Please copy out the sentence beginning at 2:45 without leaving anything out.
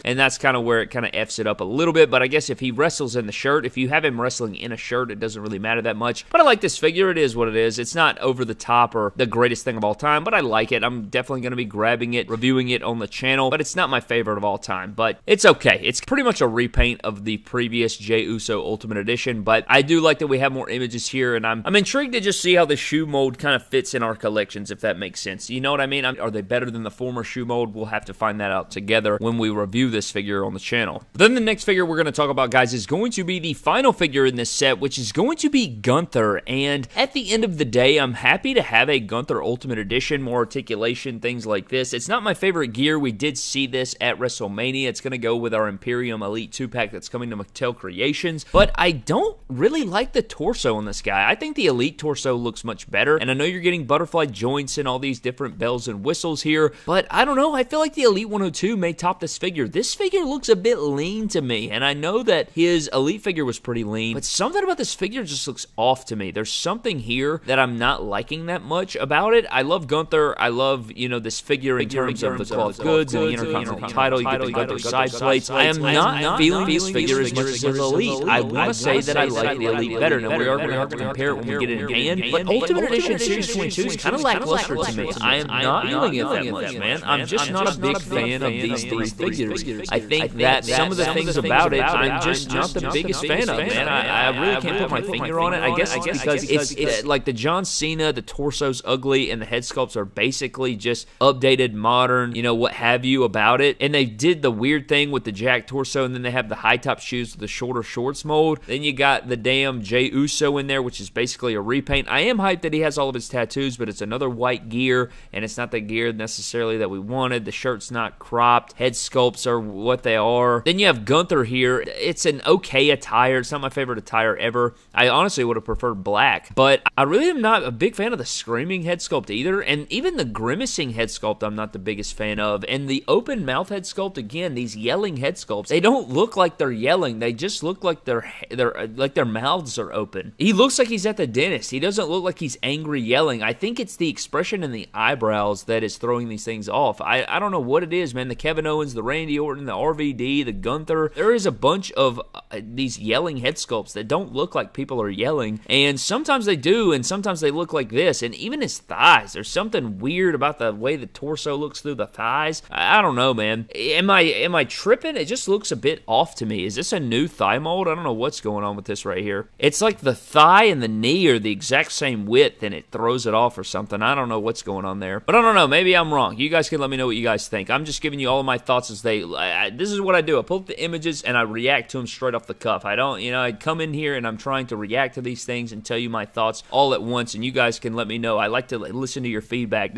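It just looks looks a bit off to me.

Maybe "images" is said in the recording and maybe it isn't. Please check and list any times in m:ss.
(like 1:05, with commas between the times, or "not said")
0:20, 3:00.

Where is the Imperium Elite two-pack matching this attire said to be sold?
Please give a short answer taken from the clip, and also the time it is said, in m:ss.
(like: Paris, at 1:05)
Mattel Creations, at 0:47.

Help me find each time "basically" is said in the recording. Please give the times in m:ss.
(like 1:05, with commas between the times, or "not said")
1:40, 1:51.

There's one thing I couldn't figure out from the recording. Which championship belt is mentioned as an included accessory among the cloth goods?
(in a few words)
Intercontinental title.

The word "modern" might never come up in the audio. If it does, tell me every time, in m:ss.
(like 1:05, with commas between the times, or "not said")
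1:41.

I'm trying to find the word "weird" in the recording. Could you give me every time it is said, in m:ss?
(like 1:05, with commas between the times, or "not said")
1:44, 2:39.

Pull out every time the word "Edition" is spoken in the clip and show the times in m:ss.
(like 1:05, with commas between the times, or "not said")
0:18, 0:39, 1:22.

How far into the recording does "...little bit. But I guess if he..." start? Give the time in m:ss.
0:01.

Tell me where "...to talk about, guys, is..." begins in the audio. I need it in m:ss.
0:32.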